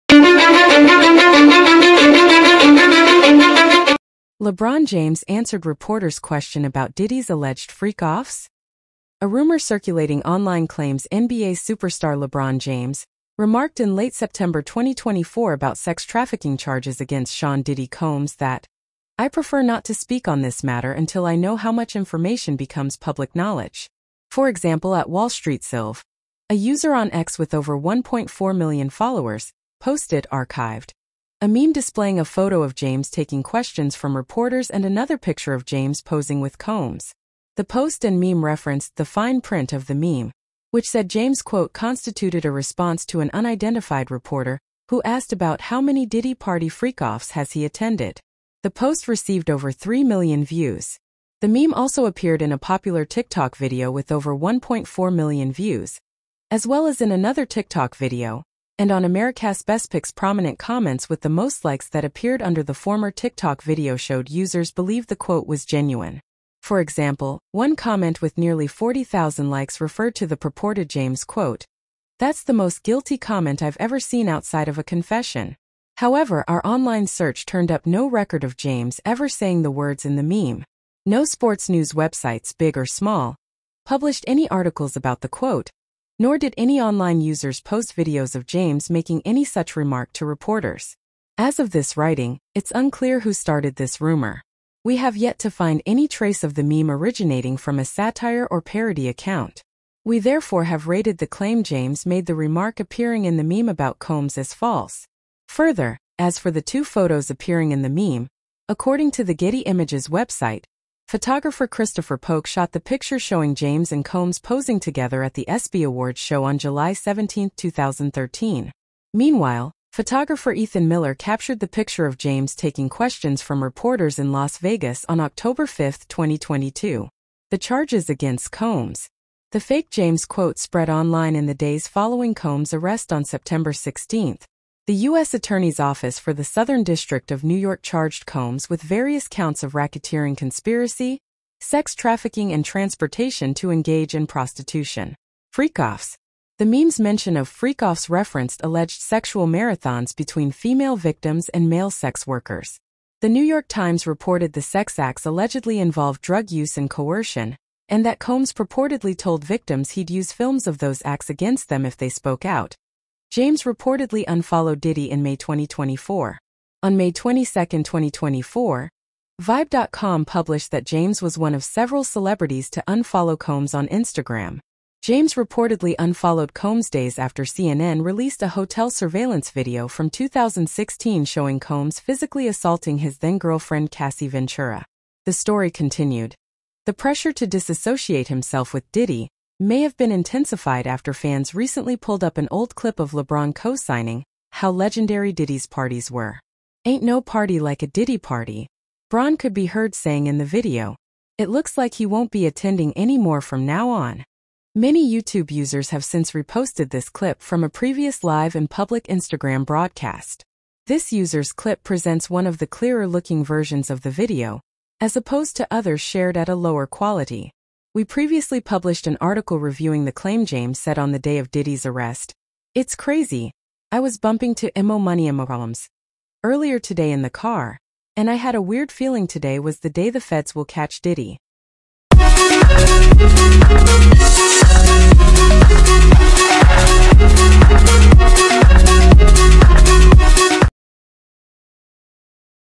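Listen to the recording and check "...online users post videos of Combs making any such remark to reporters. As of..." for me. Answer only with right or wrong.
wrong.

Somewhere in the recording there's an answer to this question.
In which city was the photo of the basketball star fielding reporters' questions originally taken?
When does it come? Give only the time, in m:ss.
2:04.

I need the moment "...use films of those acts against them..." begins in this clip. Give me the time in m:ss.
2:40.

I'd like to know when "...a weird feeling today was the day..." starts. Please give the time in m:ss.
3:48.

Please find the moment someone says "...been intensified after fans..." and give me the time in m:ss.
3:09.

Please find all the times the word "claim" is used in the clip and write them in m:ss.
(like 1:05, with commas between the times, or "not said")
0:10, 1:41, 3:40.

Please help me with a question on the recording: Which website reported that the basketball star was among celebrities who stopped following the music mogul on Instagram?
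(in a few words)
Vibe.com.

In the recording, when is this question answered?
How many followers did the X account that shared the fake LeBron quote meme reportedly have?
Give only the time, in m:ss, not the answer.
0:27.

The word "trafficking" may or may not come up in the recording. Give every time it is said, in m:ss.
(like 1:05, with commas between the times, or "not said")
0:16, 2:21.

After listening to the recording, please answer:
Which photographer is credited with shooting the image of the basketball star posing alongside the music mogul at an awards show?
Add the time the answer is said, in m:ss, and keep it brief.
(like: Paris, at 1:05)
Christopher Polk, at 1:51.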